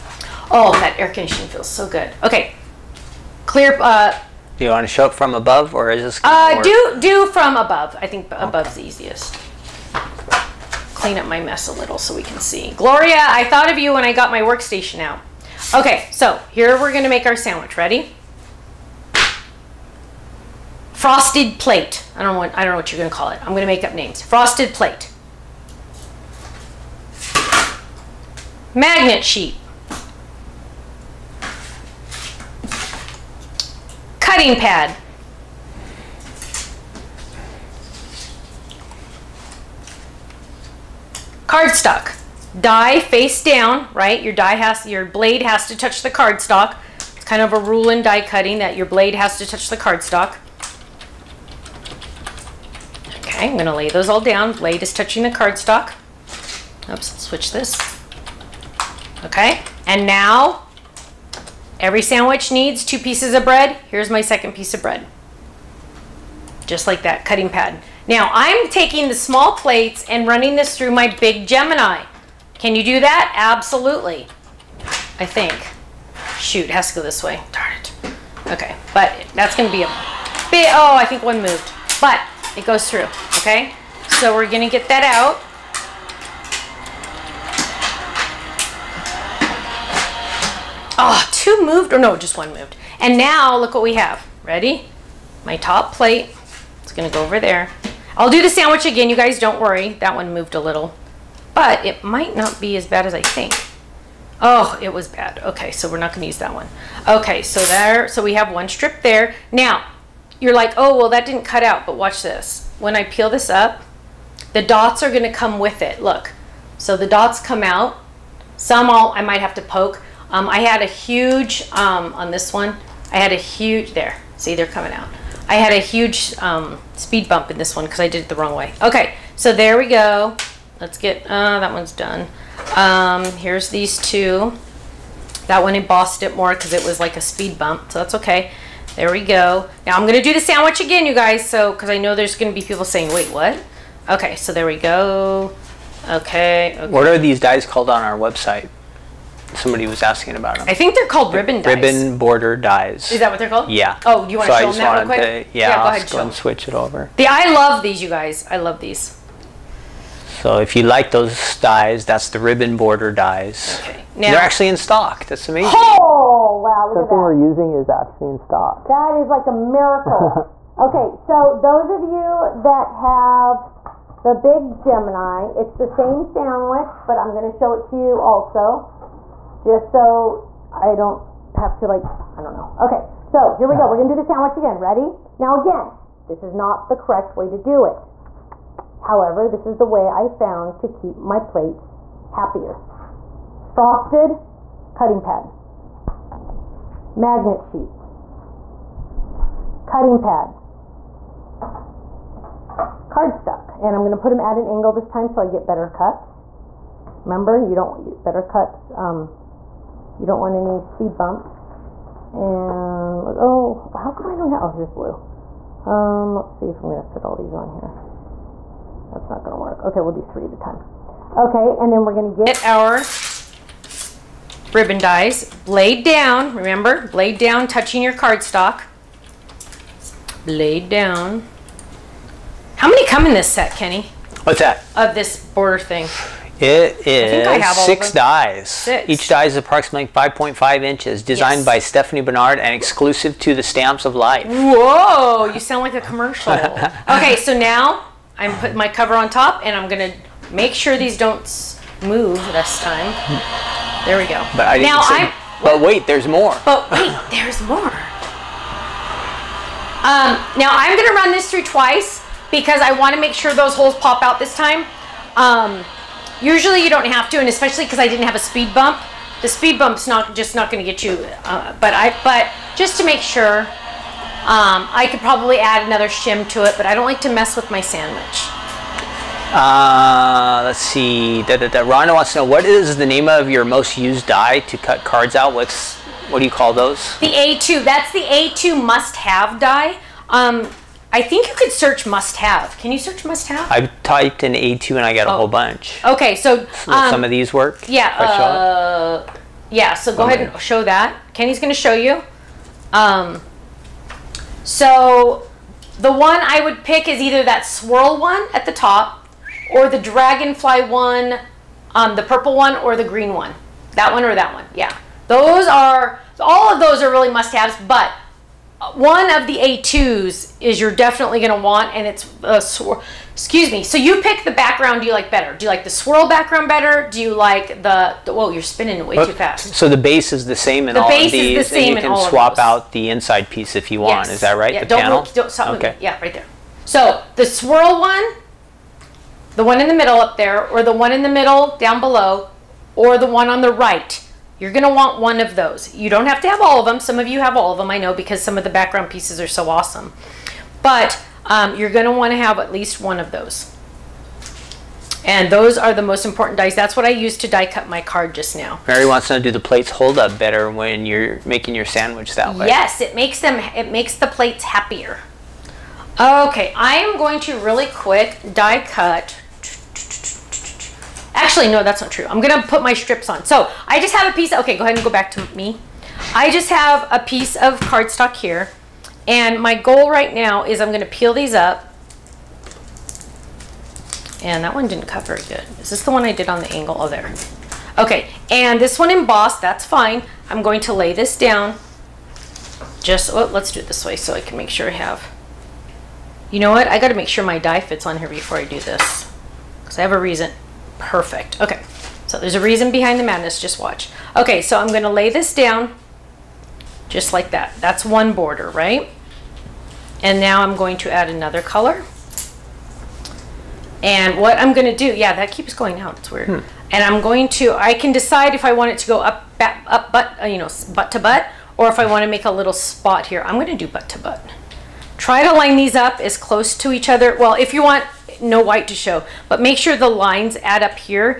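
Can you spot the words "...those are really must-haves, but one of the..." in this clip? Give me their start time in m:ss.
5:16.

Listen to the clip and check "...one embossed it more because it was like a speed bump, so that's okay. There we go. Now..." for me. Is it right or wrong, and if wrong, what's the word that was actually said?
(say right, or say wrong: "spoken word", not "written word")
right.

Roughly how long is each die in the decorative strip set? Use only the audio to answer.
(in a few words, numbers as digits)
5.5 inches.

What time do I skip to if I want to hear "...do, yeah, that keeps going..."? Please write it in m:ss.
6:54.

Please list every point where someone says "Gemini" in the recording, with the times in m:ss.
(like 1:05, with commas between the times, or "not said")
1:11, 2:54.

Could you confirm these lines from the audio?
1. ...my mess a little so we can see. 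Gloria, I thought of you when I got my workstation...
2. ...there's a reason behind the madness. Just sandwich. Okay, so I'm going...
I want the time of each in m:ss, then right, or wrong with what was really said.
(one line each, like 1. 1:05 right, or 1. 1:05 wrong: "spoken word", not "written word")
1. 0:11 right
2. 6:42 wrong: "watch", not "sandwich".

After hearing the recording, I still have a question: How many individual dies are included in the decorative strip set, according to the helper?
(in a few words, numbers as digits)
6.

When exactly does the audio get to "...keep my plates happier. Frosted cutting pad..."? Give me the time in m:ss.
3:10.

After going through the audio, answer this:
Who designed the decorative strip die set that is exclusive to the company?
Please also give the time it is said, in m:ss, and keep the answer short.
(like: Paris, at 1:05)
Stephanie Barnard, at 4:01.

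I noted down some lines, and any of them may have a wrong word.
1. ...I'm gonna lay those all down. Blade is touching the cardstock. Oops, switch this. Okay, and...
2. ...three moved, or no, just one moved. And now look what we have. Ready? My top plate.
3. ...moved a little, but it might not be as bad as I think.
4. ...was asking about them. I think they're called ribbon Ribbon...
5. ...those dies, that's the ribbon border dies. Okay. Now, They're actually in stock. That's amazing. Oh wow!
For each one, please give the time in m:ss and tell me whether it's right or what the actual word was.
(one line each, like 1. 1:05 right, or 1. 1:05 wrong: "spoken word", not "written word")
1. 0:53 right
2. 1:31 wrong: "two", not "three"
3. 1:40 right
4. 2:29 right
5. 2:41 right.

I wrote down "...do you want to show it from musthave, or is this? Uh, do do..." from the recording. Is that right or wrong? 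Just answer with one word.
wrong.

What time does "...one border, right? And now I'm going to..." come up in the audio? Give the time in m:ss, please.
6:48.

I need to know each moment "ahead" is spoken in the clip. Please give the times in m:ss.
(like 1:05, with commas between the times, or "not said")
2:35, 5:00, 6:14.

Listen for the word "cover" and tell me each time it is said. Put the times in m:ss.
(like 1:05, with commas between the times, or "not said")
4:08.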